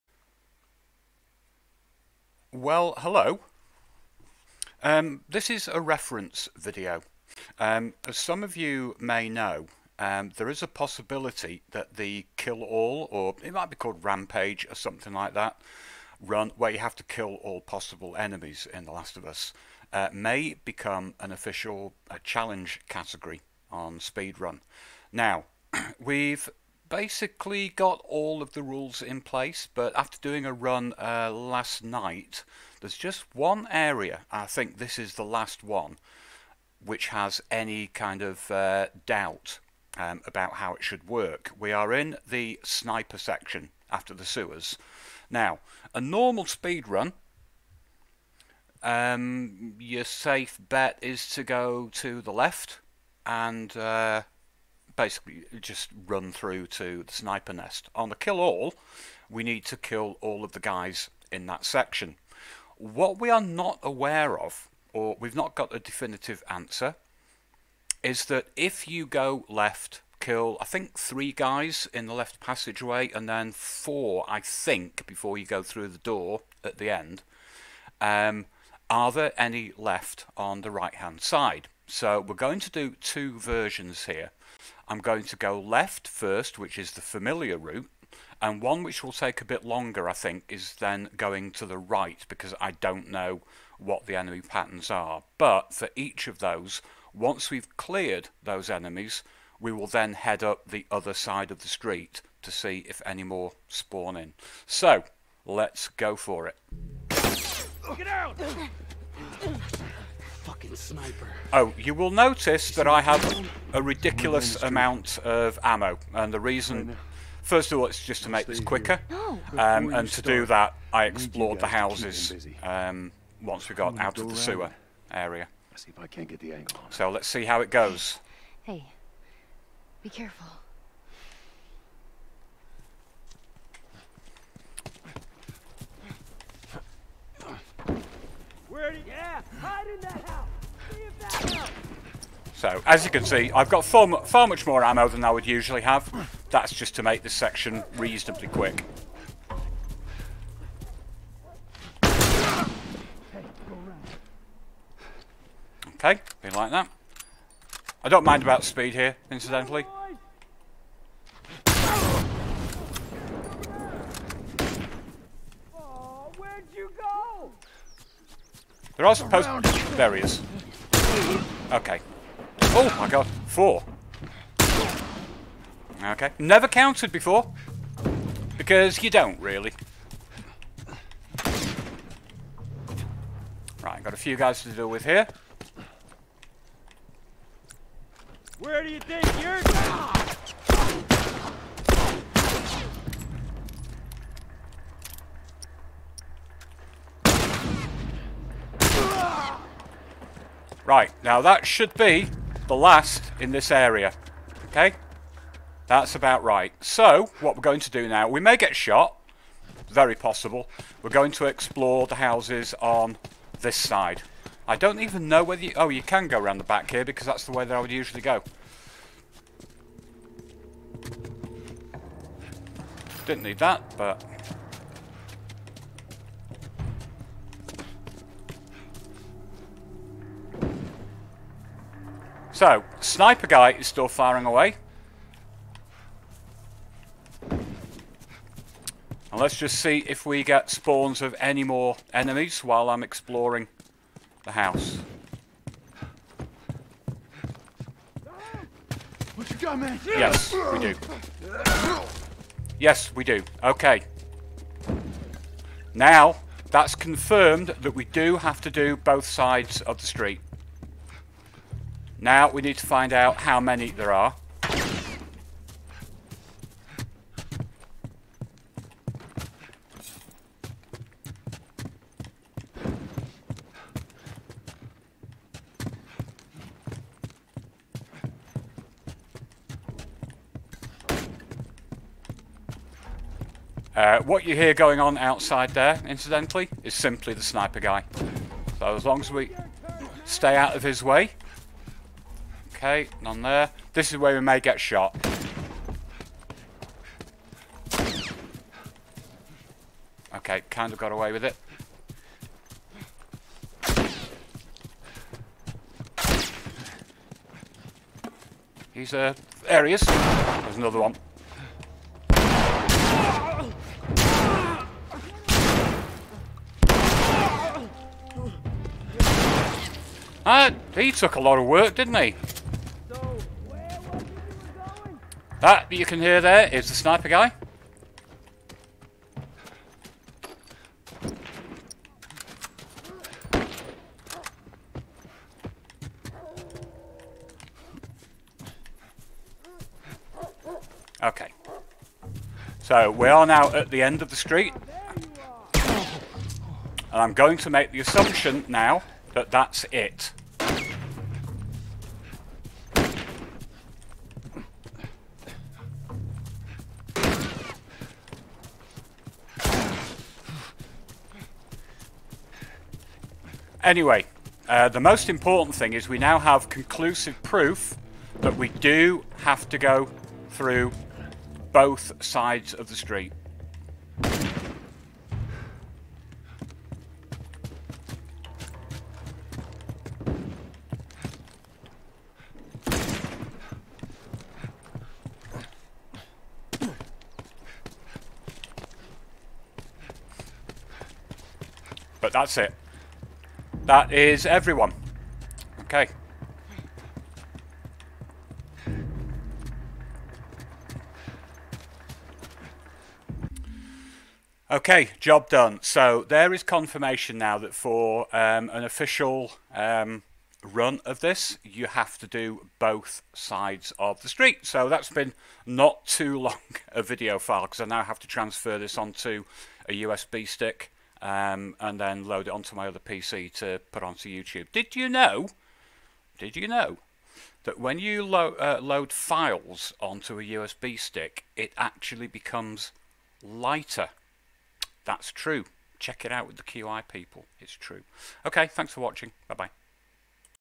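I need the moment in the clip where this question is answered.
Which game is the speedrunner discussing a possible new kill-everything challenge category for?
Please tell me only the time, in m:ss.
0:18.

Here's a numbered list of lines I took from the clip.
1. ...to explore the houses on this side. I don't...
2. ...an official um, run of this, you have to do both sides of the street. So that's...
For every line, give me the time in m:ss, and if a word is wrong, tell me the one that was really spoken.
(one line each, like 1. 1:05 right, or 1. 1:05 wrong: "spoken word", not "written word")
1. 3:31 right
2. 6:48 right.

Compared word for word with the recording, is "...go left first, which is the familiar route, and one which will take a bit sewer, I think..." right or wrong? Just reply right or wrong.
wrong.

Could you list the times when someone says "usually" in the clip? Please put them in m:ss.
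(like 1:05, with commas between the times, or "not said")
2:25, 3:37.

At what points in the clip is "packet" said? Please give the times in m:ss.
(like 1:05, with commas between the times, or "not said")
not said.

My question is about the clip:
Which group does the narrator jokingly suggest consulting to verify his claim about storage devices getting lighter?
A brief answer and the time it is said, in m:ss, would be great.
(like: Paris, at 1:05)
the QI people, at 7:16.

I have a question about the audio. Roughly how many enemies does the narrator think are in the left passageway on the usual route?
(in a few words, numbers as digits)
3.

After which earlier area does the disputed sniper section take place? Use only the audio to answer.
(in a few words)
the sewers.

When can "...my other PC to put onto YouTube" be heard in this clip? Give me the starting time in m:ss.
7:02.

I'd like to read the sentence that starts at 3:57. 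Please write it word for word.
And let's just see if we get spawns of any more enemies while I'm exploring the house.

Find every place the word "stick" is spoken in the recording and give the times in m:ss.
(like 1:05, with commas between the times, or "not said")
7:00, 7:10.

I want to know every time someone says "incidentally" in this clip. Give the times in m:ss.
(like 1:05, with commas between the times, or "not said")
2:39, 4:46.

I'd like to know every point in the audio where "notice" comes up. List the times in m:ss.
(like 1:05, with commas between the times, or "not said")
1:52.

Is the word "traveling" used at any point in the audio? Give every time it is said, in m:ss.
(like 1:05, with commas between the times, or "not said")
not said.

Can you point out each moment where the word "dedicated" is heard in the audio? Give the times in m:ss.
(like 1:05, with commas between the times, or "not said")
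not said.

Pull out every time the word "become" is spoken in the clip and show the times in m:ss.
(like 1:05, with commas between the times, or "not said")
0:20, 7:12.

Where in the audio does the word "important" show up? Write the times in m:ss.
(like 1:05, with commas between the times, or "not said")
6:05.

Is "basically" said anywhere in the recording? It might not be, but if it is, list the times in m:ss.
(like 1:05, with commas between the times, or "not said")
0:26, 0:54.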